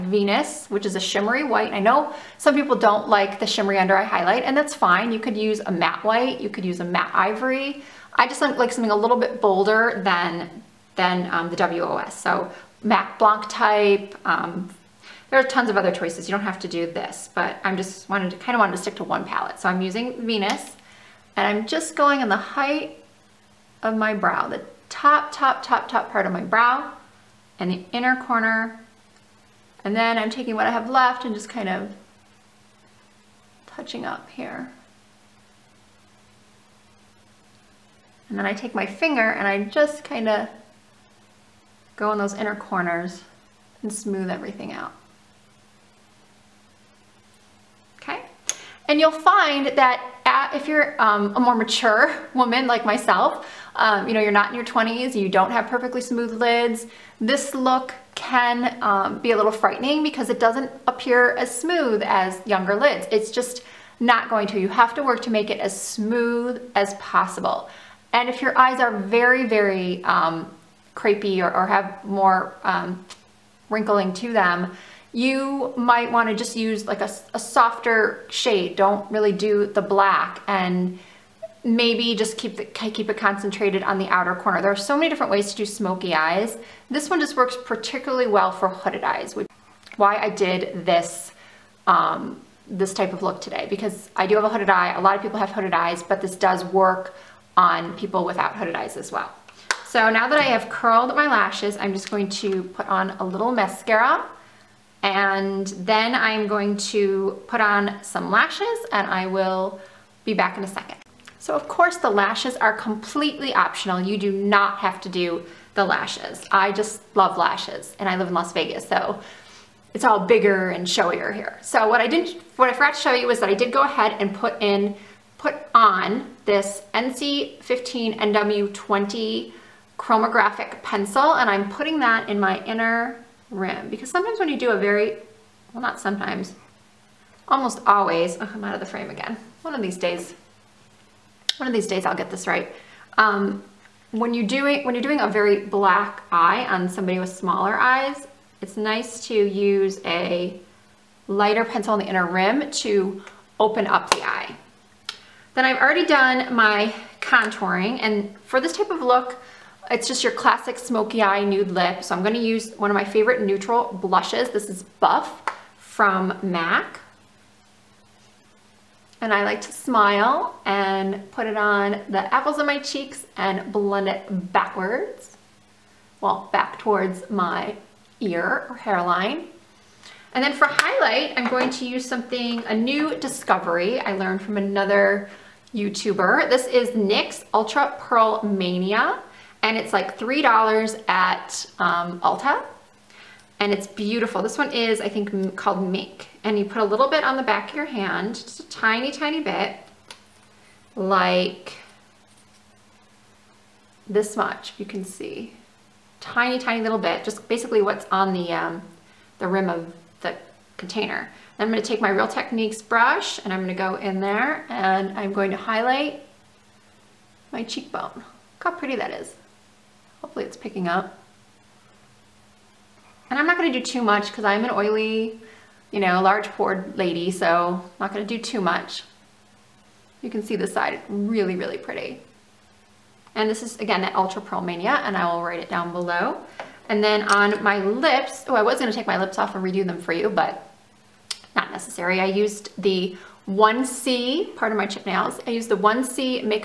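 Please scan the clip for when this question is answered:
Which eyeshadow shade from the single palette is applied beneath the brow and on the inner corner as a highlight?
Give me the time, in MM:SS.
00:20.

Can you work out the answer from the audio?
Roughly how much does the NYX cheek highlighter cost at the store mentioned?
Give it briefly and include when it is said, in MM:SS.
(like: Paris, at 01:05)
$3, at 03:10.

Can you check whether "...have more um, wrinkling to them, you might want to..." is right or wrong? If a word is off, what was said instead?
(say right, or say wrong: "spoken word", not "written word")
right.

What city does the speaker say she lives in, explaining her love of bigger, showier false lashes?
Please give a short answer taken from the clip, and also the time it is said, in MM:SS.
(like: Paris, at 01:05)
Las Vegas, at 01:58.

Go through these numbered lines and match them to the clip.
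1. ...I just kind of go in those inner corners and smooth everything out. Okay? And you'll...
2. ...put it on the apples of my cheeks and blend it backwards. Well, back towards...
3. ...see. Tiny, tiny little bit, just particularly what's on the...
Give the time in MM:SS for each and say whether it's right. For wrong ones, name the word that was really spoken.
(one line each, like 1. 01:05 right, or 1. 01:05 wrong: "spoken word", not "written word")
1. 00:39 right
2. 02:51 right
3. 03:25 wrong: "basically", not "particularly".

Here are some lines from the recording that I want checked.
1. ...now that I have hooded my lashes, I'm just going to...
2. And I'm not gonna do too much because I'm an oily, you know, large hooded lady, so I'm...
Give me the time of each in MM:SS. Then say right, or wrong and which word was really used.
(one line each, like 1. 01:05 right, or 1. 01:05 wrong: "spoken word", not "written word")
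1. 01:40 wrong: "curled", not "hooded"
2. 03:43 wrong: "pored", not "hooded".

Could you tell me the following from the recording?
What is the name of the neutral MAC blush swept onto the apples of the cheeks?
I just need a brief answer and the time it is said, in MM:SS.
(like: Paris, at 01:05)
Buff, at 02:45.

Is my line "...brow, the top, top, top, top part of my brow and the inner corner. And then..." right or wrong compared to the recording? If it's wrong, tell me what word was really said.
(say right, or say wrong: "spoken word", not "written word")
right.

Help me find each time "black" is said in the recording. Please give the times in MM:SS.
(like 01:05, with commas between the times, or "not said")
01:19, 02:25.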